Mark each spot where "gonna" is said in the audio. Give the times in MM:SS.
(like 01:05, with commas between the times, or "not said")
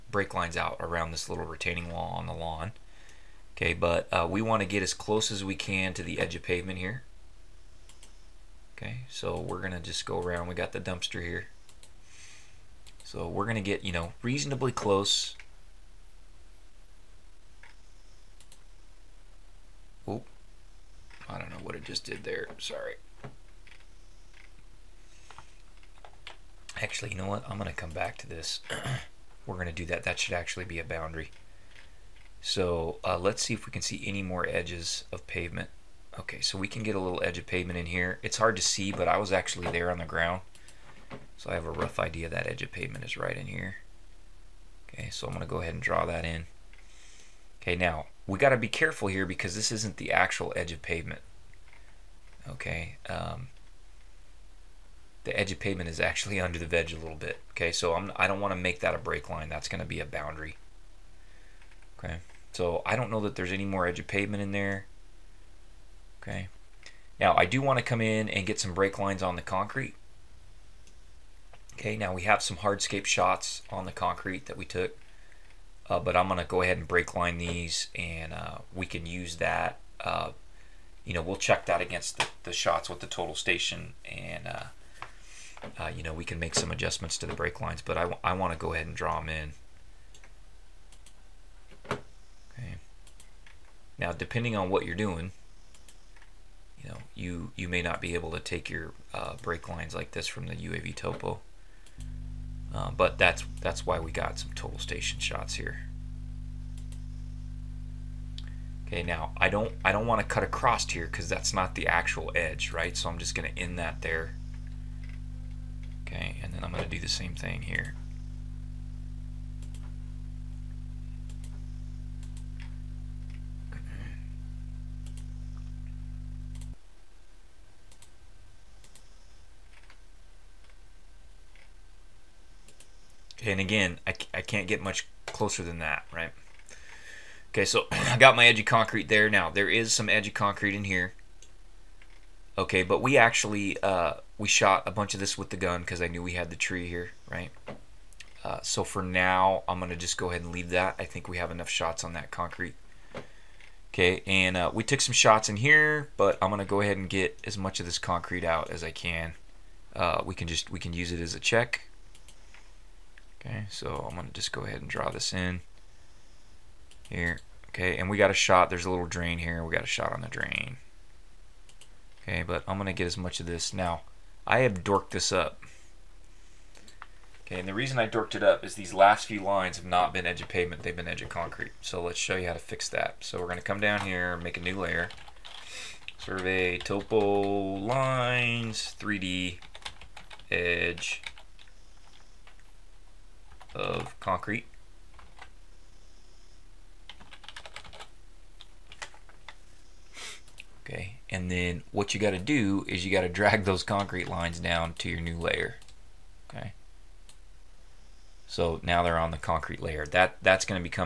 03:03.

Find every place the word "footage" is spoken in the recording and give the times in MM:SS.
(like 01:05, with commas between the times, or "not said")
not said.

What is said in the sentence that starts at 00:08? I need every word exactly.
Okay, so we're going to just go around.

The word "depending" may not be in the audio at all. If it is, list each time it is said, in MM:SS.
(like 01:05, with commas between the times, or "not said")
01:34.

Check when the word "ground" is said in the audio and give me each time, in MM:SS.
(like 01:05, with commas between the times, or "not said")
00:40.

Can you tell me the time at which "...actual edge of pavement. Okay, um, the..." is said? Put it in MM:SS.
00:50.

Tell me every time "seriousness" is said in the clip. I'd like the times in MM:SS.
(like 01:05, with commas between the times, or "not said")
not said.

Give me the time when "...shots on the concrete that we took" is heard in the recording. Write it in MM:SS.
01:13.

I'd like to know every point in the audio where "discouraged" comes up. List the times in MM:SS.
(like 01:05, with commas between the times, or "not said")
not said.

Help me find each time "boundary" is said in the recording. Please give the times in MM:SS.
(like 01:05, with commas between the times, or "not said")
00:30, 01:00.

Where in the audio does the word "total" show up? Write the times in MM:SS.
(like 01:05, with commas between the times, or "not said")
01:23, 01:44.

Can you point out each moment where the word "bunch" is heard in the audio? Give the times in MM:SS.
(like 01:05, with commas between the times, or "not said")
02:24.